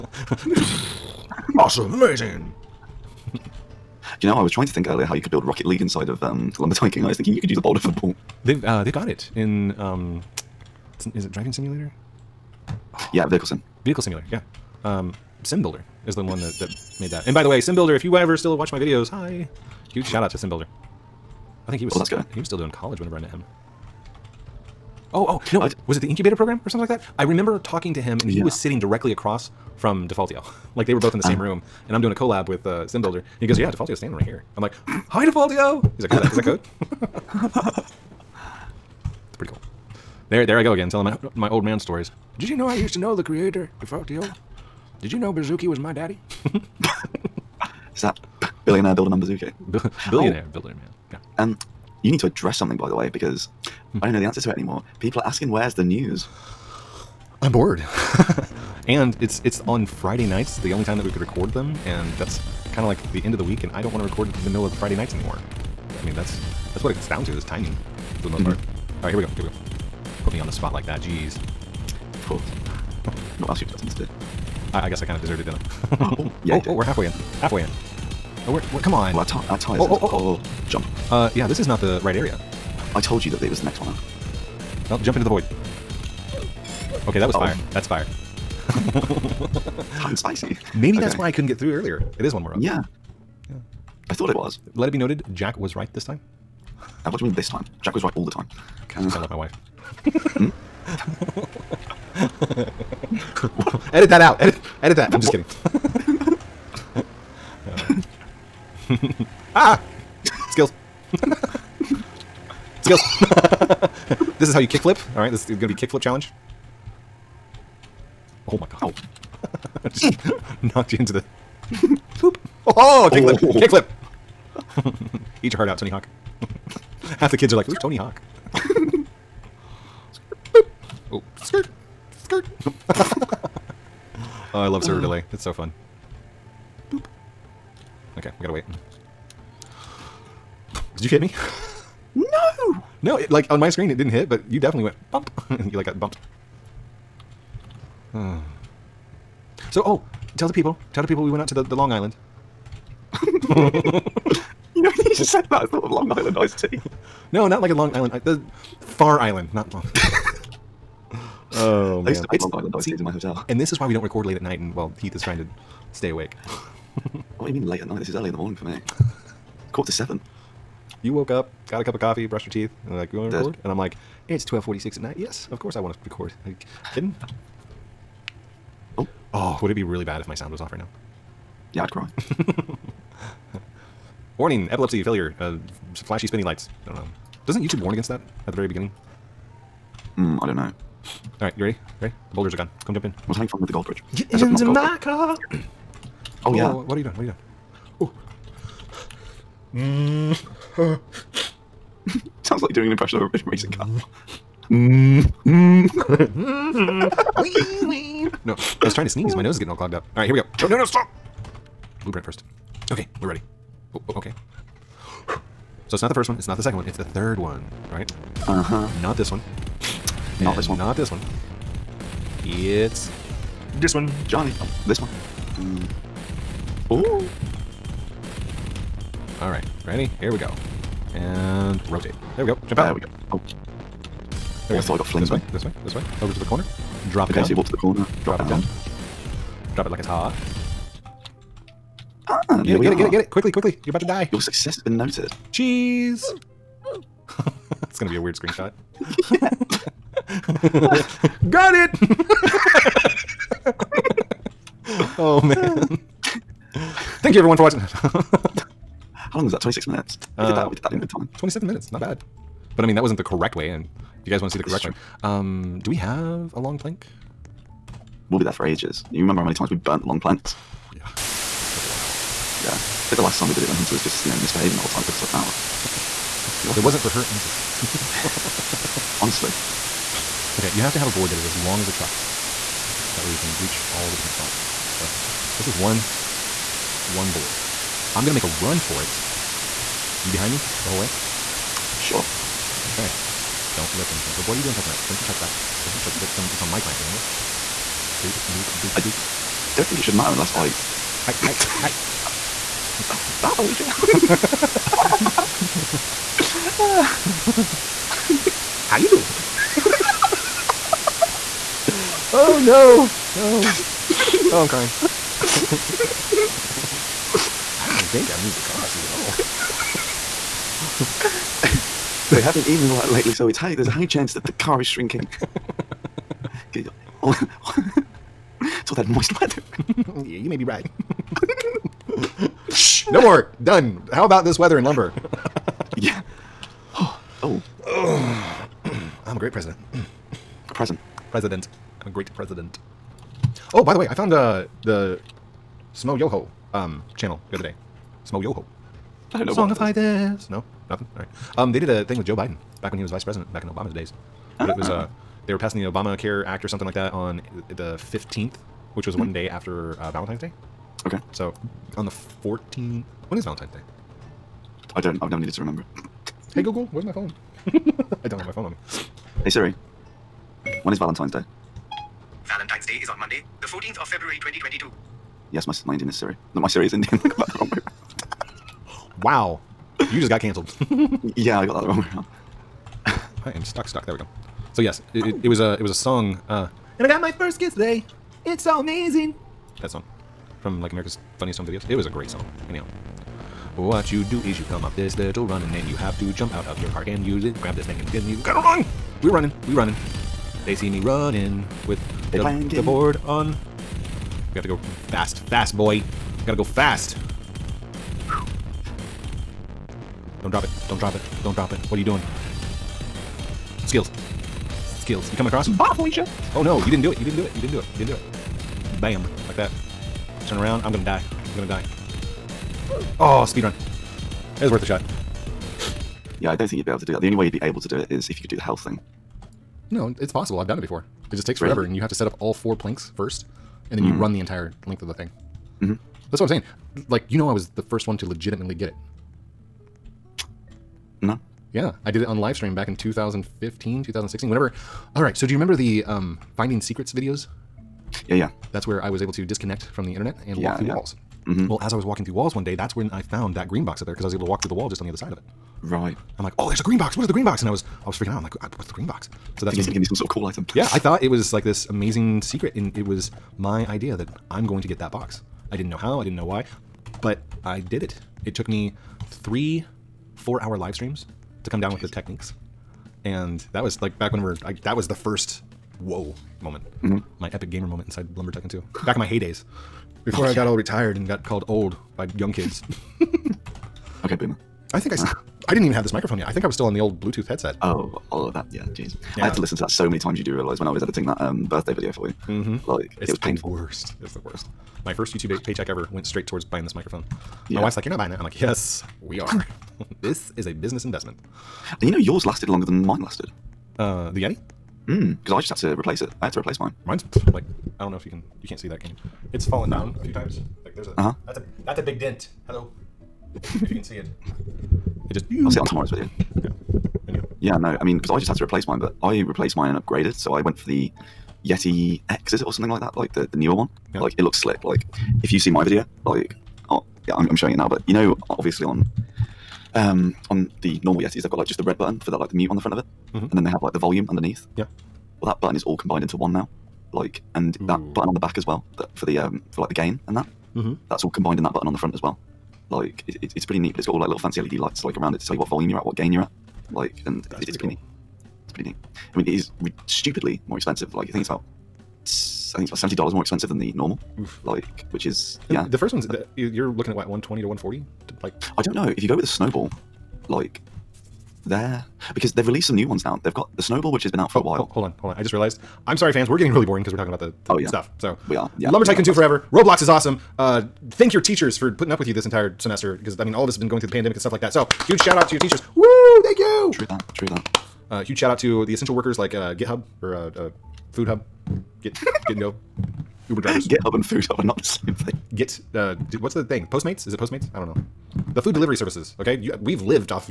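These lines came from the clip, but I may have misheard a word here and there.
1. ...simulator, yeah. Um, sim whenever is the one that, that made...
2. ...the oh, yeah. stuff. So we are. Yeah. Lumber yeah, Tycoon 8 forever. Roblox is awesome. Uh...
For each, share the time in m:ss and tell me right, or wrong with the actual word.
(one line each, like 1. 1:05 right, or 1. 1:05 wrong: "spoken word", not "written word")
1. 0:13 wrong: "builder", not "whenever"
2. 9:27 wrong: "2", not "8".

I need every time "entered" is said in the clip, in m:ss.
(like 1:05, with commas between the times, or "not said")
not said.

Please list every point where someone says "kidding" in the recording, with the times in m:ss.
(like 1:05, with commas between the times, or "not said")
1:45, 2:56.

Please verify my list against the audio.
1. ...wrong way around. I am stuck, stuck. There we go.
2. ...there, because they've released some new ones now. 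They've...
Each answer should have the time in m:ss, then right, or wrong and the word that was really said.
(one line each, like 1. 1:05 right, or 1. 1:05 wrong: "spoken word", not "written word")
1. 6:21 right
2. 9:21 right.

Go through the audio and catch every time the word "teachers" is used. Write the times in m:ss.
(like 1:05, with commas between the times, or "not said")
9:31, 9:35.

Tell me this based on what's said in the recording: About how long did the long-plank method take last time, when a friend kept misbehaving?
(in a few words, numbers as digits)
An hour.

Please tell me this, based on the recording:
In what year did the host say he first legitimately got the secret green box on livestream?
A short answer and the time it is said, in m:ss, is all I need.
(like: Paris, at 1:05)
2015, at 7:22.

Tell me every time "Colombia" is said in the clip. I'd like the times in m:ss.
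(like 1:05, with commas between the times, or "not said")
not said.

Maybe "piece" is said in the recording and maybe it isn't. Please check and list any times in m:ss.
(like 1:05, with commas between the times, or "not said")
not said.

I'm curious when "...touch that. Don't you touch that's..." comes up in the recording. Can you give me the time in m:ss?
4:55.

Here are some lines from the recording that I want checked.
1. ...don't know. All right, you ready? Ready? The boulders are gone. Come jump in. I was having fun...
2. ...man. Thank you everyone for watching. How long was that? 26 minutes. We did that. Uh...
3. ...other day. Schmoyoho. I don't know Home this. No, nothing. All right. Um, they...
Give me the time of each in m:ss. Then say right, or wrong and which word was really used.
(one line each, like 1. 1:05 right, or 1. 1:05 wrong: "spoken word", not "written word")
1. 3:10 right
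2. 4:15 right
3. 5:47 wrong: "Songify", not "Home".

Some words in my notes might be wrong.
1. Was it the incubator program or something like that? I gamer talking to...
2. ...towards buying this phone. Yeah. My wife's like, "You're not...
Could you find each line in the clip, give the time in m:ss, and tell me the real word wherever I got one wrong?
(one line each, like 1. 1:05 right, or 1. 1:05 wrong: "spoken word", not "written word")
1. 0:25 wrong: "remember", not "gamer"
2. 8:16 wrong: "microphone", not "phone".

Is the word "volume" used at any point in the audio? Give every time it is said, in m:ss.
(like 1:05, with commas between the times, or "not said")
8:53, 9:05.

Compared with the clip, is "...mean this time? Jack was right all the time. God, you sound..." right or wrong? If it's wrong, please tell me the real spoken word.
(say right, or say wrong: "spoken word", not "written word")
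right.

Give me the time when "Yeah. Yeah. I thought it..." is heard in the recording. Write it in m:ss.
1:32.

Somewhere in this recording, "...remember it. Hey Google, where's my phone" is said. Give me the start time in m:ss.
6:05.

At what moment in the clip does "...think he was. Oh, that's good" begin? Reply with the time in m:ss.
0:21.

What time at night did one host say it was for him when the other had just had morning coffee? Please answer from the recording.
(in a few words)
12:46.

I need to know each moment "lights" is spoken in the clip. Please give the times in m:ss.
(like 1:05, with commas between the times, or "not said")
3:06, 9:04.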